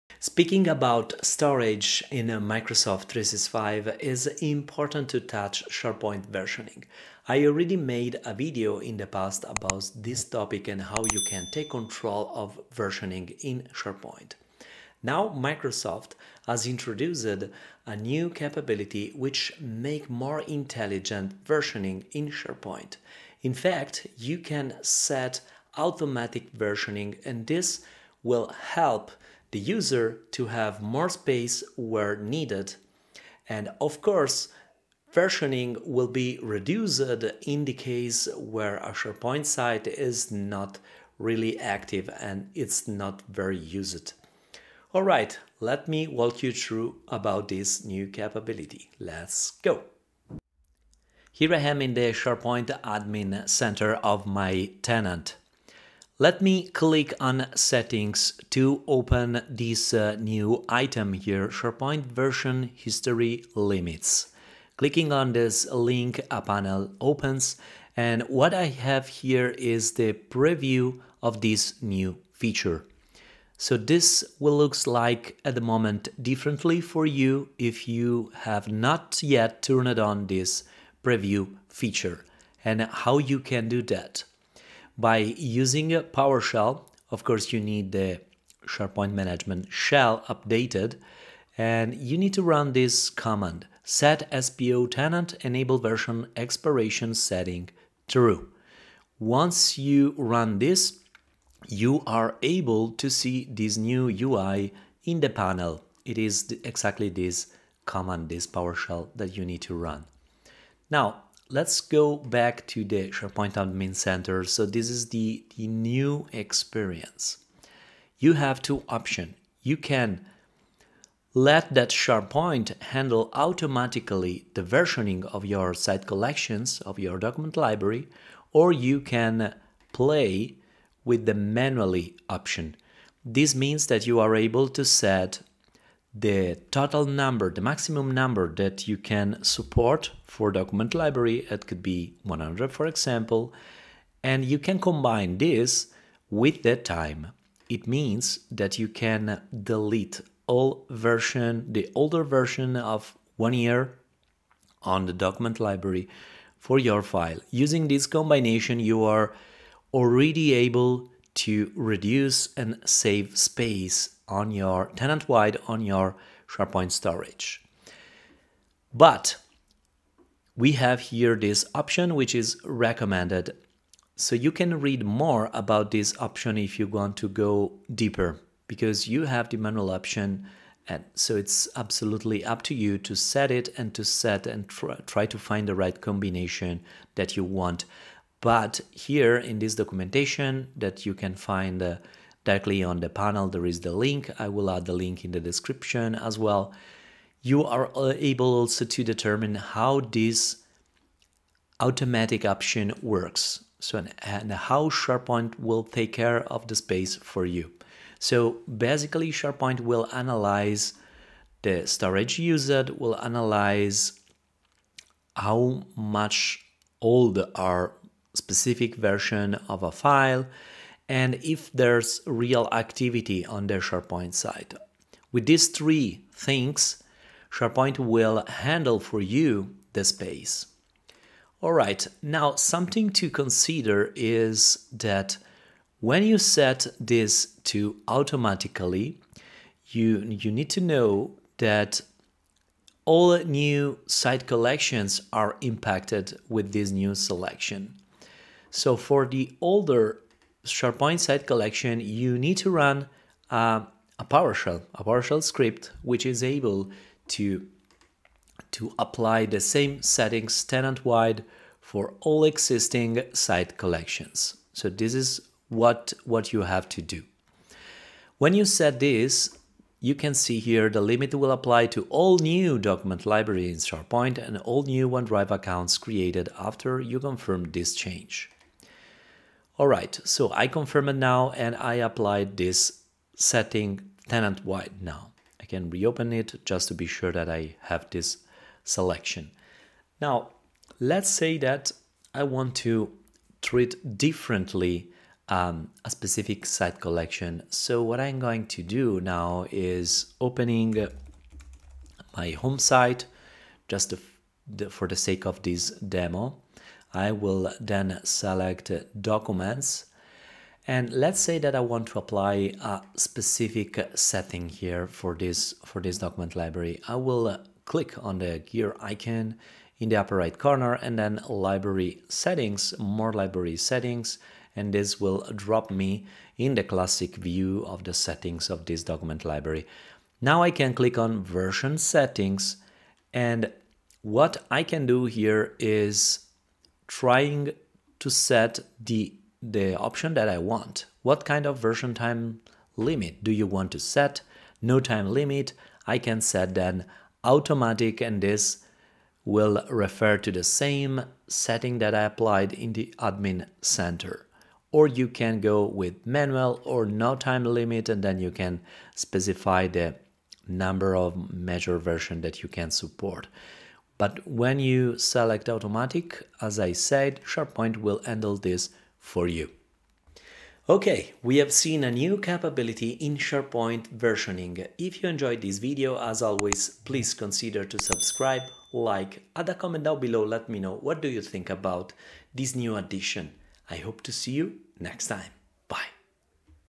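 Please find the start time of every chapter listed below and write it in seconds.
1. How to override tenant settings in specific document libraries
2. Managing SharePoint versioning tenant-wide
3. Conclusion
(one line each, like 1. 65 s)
1. 231 s
2. 50 s
3. 370 s.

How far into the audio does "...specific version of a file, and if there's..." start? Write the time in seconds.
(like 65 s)
218 s.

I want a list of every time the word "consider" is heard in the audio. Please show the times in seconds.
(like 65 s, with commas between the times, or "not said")
233 s, 377 s.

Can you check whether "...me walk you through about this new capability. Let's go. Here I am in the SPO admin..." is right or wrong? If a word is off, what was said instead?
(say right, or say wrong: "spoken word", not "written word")
wrong: "SharePoint", not "SPO".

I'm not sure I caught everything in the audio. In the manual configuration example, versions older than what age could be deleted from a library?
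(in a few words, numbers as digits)
one year.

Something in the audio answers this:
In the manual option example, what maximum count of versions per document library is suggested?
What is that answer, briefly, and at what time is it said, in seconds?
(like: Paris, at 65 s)
100, at 142 s.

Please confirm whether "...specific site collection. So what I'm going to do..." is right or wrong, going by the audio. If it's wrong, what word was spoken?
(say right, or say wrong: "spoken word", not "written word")
right.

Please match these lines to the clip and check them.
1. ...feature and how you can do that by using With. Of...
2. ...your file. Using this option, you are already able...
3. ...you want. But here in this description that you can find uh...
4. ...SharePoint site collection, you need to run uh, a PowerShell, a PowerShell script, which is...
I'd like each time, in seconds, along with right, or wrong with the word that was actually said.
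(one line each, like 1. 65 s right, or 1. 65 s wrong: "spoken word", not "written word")
1. 81 s wrong: "PowerShell", not "With"
2. 156 s wrong: "combination", not "option"
3. 187 s wrong: "documentation", not "description"
4. 250 s right.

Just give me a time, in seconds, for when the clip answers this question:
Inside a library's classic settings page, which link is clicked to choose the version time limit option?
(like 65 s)
331 s.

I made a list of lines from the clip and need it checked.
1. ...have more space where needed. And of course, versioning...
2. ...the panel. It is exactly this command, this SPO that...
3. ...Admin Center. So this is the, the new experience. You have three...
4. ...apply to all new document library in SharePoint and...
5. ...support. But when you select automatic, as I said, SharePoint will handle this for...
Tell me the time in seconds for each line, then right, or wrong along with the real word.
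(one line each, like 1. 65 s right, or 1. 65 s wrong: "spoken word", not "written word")
1. 30 s right
2. 105 s wrong: "PowerShell", not "SPO"
3. 113 s wrong: "two", not "three"
4. 271 s right
5. 362 s right.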